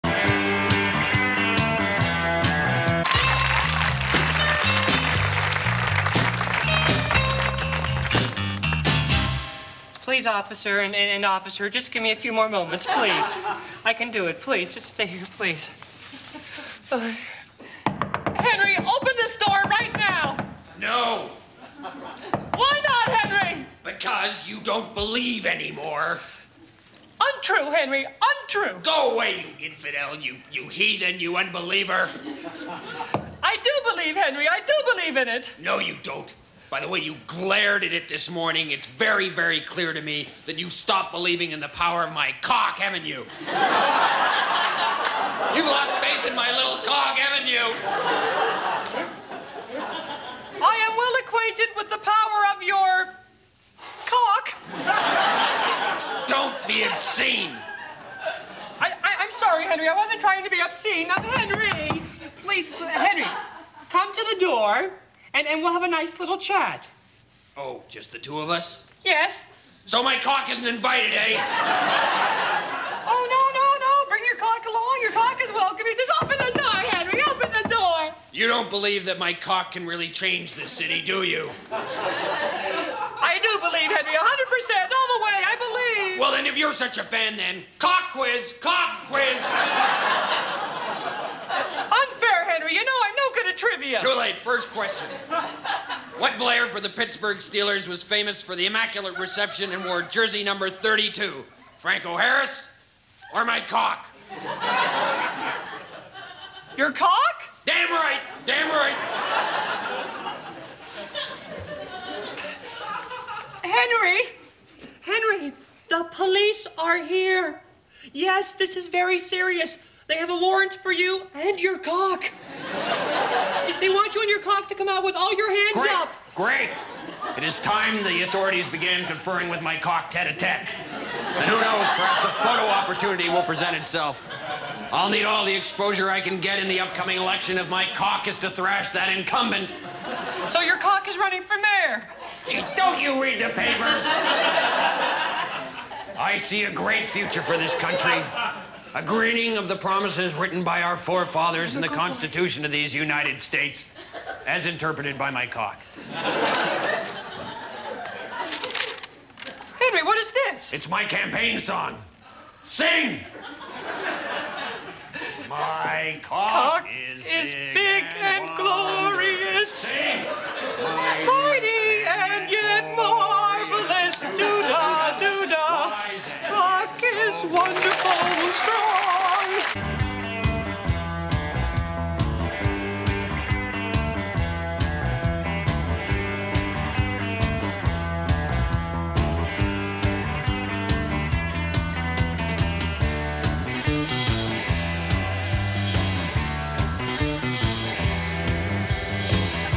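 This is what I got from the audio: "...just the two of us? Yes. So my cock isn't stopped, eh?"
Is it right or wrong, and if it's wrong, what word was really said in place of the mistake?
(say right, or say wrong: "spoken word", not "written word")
wrong: "invited", not "stopped".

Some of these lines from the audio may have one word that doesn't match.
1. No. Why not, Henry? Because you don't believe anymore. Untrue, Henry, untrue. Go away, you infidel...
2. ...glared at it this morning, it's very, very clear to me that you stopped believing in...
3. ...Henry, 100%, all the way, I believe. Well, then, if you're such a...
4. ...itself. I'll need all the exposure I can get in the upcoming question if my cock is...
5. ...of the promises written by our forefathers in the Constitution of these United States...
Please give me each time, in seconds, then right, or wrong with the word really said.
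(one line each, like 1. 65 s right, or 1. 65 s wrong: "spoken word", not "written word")
1. 20 s right
2. 37 s right
3. 83 s right
4. 133 s wrong: "election", not "question"
5. 149 s right.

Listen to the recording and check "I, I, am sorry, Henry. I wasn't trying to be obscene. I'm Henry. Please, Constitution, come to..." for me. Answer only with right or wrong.
wrong.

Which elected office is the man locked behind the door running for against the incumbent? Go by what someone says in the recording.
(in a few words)
Mayor.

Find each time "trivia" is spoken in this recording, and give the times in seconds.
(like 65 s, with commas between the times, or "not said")
93 s.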